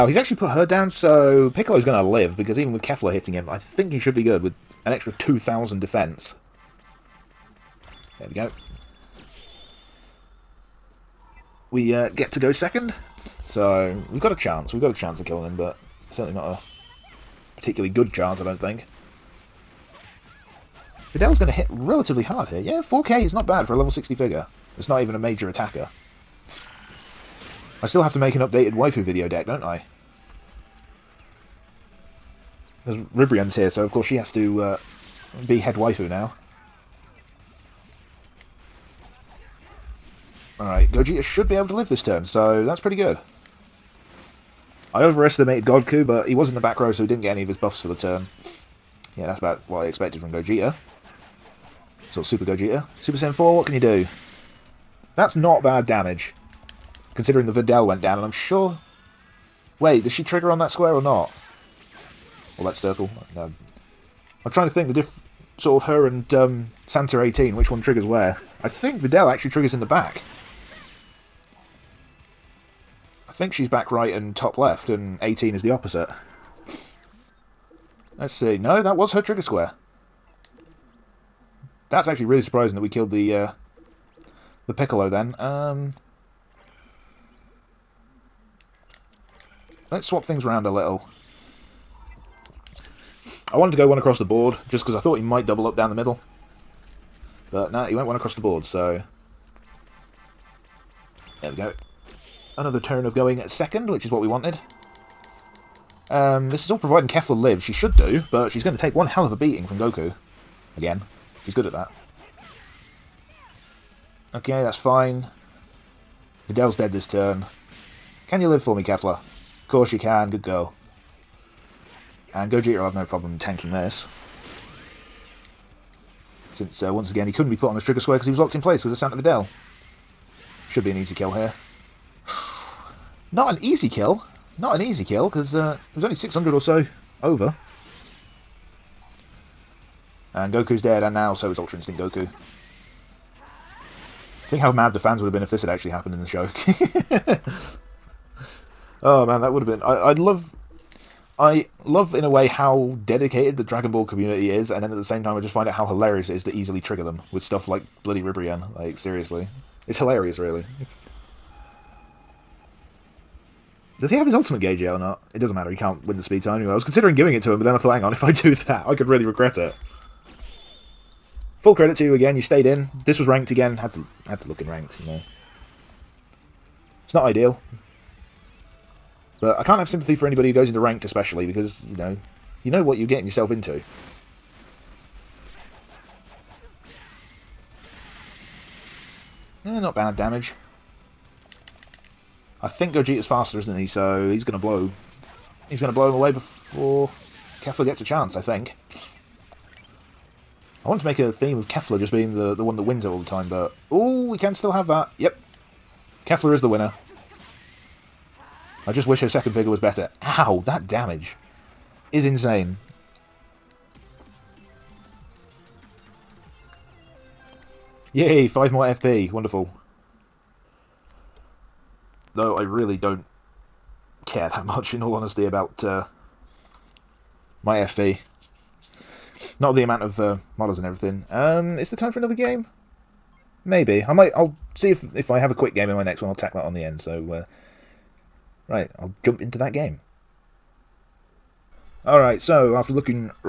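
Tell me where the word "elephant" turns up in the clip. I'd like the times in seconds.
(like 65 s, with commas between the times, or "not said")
not said.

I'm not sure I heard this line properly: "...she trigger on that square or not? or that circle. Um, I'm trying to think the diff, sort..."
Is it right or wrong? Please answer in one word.
right.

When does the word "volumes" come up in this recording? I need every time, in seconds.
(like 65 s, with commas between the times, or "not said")
not said.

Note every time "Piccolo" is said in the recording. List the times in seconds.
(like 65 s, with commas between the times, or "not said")
1 s, 84 s.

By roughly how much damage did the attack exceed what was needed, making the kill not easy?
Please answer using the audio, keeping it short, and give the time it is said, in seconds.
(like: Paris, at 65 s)
600, at 136 s.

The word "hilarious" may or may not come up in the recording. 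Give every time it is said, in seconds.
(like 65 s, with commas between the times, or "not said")
155 s, 159 s.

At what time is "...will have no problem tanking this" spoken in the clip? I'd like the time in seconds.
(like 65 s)
122 s.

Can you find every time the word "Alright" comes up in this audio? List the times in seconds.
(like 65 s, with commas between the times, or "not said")
40 s, 242 s.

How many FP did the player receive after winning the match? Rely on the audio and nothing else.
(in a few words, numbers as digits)
5.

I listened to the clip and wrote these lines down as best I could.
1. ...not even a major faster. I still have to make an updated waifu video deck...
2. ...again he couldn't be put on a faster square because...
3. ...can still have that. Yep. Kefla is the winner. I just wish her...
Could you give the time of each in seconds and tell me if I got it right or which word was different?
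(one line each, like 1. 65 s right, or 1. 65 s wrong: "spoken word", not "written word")
1. 24 s wrong: "attacker", not "faster"
2. 127 s wrong: "trigger", not "faster"
3. 204 s right.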